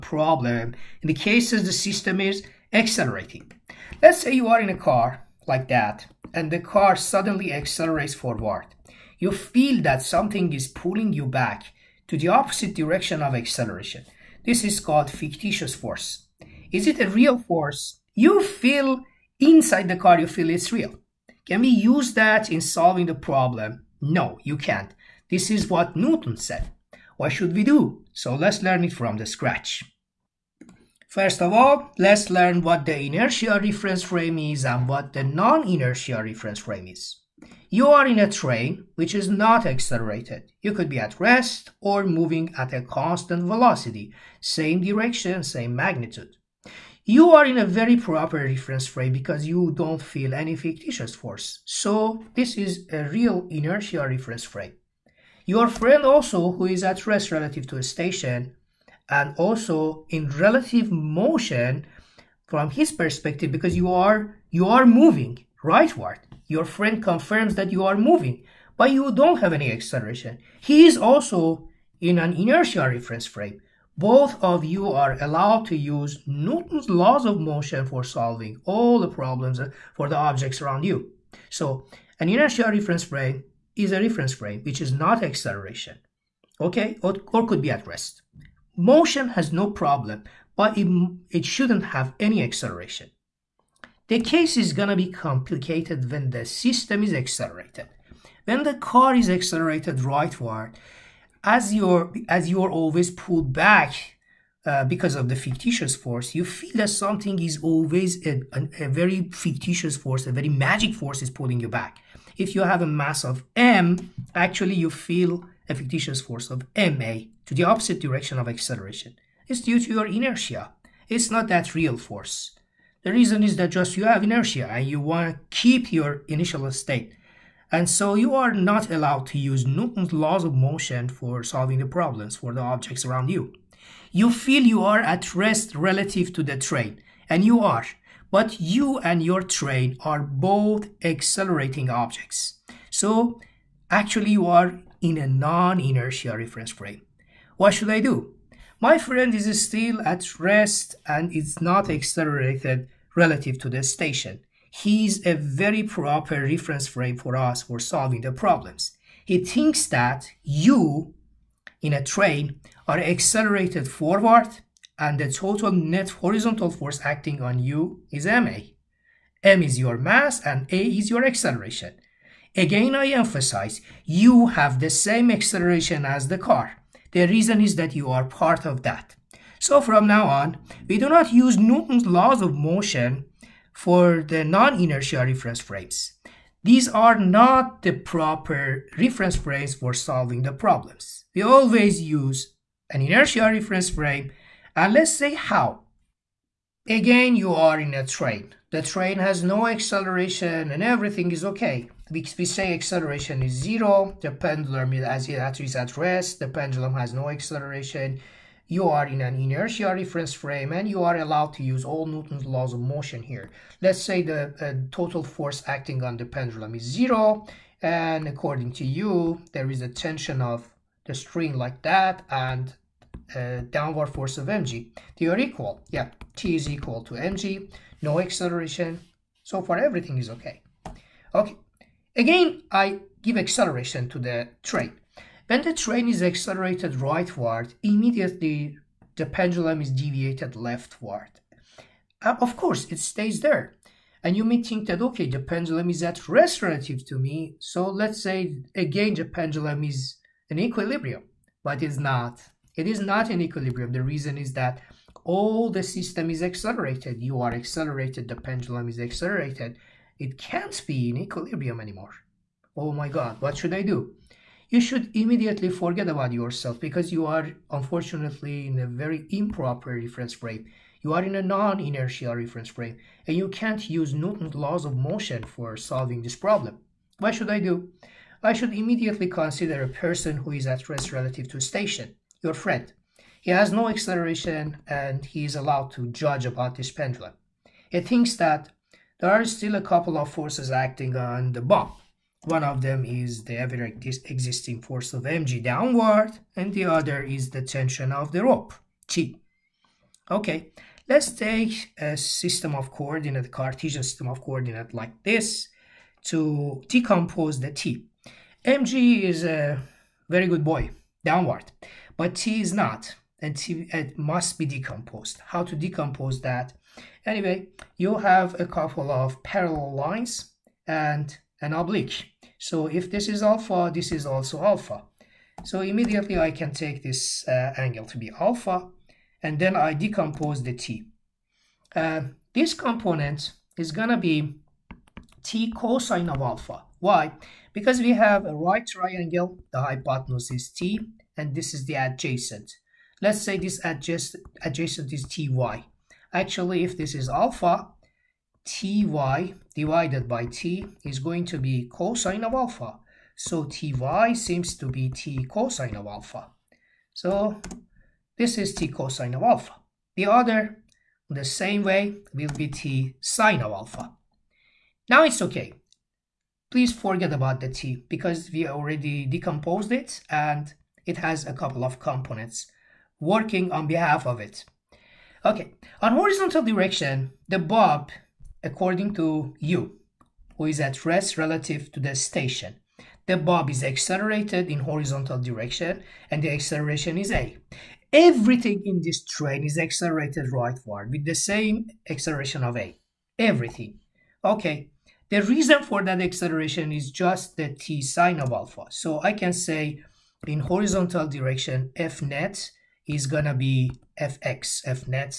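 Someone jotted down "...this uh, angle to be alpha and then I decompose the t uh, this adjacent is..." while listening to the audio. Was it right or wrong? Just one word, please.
wrong.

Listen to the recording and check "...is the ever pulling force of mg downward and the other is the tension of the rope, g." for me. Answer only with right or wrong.
wrong.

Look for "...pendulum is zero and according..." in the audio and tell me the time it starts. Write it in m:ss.
3:36.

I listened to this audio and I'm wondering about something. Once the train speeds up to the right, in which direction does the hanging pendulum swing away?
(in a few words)
leftward.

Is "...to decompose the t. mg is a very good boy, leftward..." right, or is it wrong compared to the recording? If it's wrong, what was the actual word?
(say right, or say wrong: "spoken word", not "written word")
wrong: "downward", not "leftward".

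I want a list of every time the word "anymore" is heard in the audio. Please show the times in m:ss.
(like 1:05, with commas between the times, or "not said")
4:21.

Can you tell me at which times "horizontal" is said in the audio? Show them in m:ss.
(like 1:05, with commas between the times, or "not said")
2:46, 6:16, 6:24, 6:40.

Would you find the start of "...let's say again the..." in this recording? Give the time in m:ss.
4:07.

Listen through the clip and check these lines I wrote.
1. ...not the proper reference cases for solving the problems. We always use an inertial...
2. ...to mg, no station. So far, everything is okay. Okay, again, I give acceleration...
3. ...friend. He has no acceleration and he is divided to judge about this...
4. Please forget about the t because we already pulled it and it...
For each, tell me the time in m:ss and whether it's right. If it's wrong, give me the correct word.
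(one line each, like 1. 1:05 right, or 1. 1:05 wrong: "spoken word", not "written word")
1. 3:07 wrong: "frames", not "cases"
2. 3:47 wrong: "acceleration", not "station"
3. 4:42 wrong: "allowed", not "divided"
4. 6:06 wrong: "decomposed", not "pulled".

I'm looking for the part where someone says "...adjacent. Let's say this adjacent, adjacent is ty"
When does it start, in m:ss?
5:41.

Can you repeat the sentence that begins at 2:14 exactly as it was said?
You feel you are at rest relative to the train, and you are but you and your train are both accelerating objects.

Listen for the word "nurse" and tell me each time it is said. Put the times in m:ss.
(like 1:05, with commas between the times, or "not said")
not said.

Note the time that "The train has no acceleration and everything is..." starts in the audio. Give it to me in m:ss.
3:18.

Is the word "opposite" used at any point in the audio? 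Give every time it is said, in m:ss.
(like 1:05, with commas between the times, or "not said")
0:12, 1:57.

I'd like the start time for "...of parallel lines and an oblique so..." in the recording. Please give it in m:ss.
5:19.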